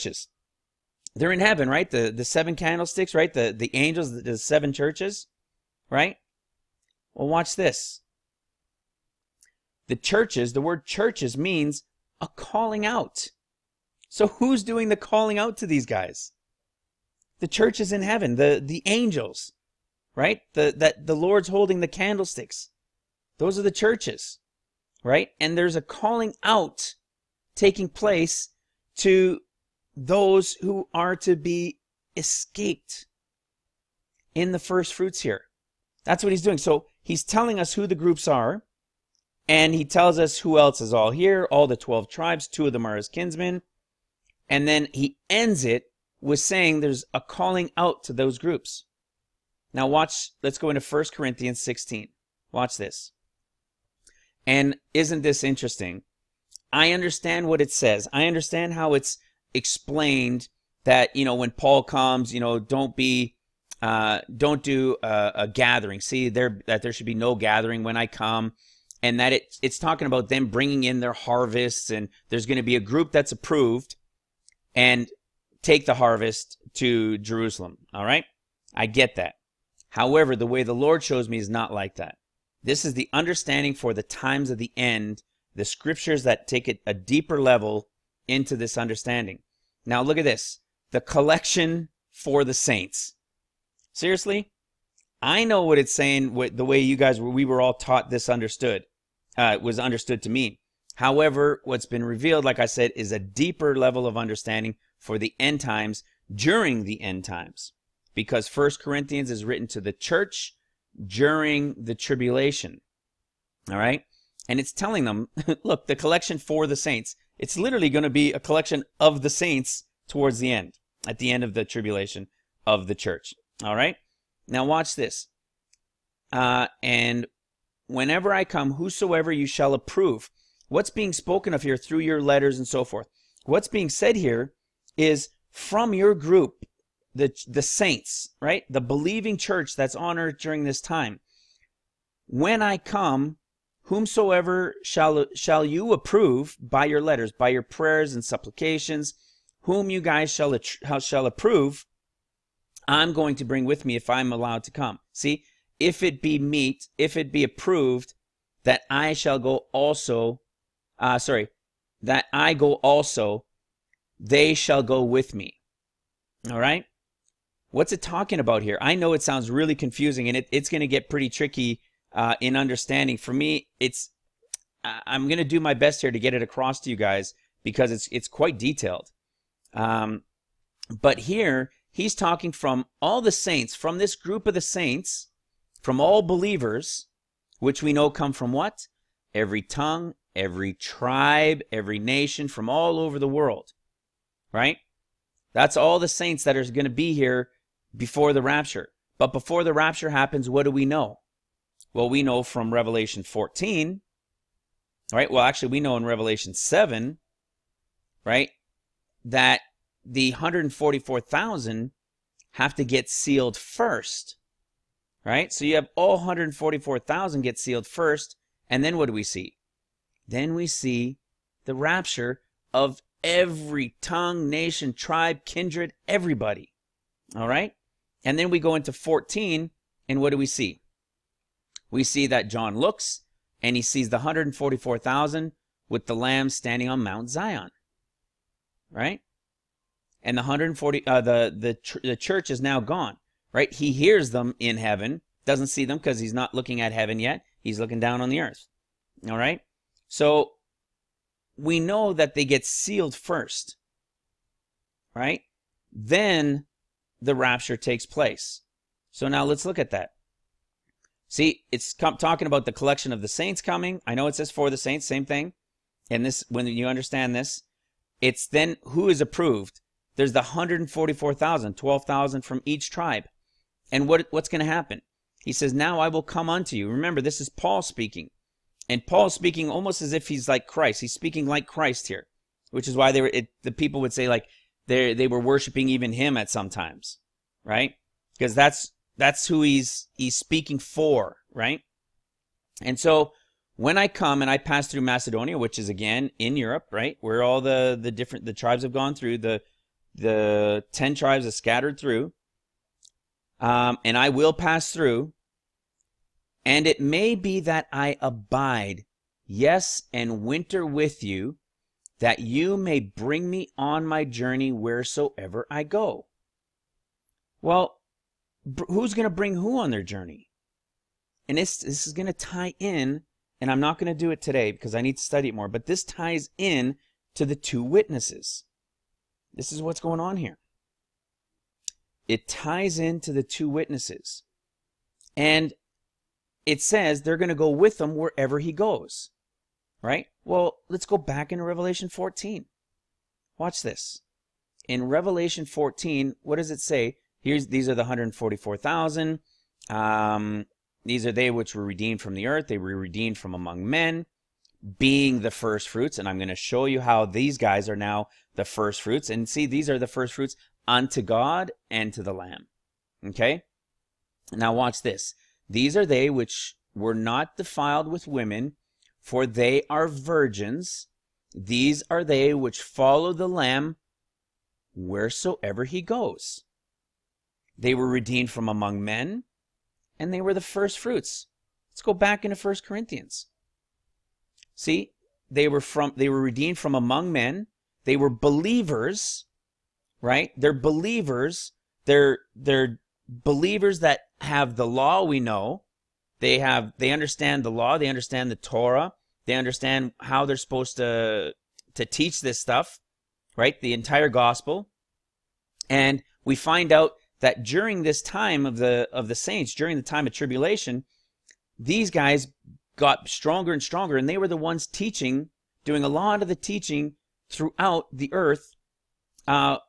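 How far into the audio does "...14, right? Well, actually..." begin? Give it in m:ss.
3:23.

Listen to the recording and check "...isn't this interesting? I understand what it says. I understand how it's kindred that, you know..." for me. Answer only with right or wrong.
wrong.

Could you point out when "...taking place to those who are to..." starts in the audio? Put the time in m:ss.
0:27.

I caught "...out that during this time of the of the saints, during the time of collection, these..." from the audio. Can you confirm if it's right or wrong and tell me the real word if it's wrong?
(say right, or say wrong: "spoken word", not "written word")
wrong: "tribulation", not "collection".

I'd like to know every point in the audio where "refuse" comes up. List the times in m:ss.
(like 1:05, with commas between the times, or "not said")
not said.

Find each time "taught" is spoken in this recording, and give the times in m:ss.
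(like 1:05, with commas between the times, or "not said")
1:37.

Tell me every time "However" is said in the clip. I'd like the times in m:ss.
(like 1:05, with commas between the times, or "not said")
1:19, 1:40.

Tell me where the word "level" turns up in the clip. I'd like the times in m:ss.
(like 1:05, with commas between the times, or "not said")
1:27, 1:43.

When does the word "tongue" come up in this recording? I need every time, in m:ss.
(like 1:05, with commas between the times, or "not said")
3:09, 3:44.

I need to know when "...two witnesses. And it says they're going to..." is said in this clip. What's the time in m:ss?
5:33.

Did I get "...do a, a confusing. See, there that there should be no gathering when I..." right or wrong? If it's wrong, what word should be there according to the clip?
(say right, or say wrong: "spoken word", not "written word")
wrong: "gathering", not "confusing".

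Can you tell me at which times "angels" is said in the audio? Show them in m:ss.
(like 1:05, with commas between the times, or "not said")
0:03, 0:18.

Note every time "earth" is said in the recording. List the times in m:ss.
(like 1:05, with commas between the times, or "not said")
2:20, 4:08, 5:52, 6:58.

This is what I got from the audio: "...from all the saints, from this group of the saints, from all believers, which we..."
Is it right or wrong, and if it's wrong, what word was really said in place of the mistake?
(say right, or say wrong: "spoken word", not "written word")
right.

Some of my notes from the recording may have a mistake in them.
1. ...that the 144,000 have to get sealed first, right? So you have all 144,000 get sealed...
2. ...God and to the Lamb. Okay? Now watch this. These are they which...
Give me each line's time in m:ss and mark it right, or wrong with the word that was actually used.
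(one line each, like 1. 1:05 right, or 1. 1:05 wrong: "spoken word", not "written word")
1. 3:29 right
2. 6:01 right.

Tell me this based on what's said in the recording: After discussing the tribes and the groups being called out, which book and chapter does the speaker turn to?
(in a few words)
1 Corinthians 16.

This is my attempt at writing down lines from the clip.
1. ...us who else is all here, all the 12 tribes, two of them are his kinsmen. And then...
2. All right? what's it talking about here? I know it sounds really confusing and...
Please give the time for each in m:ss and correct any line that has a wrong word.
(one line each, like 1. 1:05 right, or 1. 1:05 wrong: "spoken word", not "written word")
1. 0:40 right
2. 2:46 right.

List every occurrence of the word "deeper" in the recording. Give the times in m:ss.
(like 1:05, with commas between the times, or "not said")
1:26, 1:43.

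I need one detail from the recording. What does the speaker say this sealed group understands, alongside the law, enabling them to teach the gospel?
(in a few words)
The Torah.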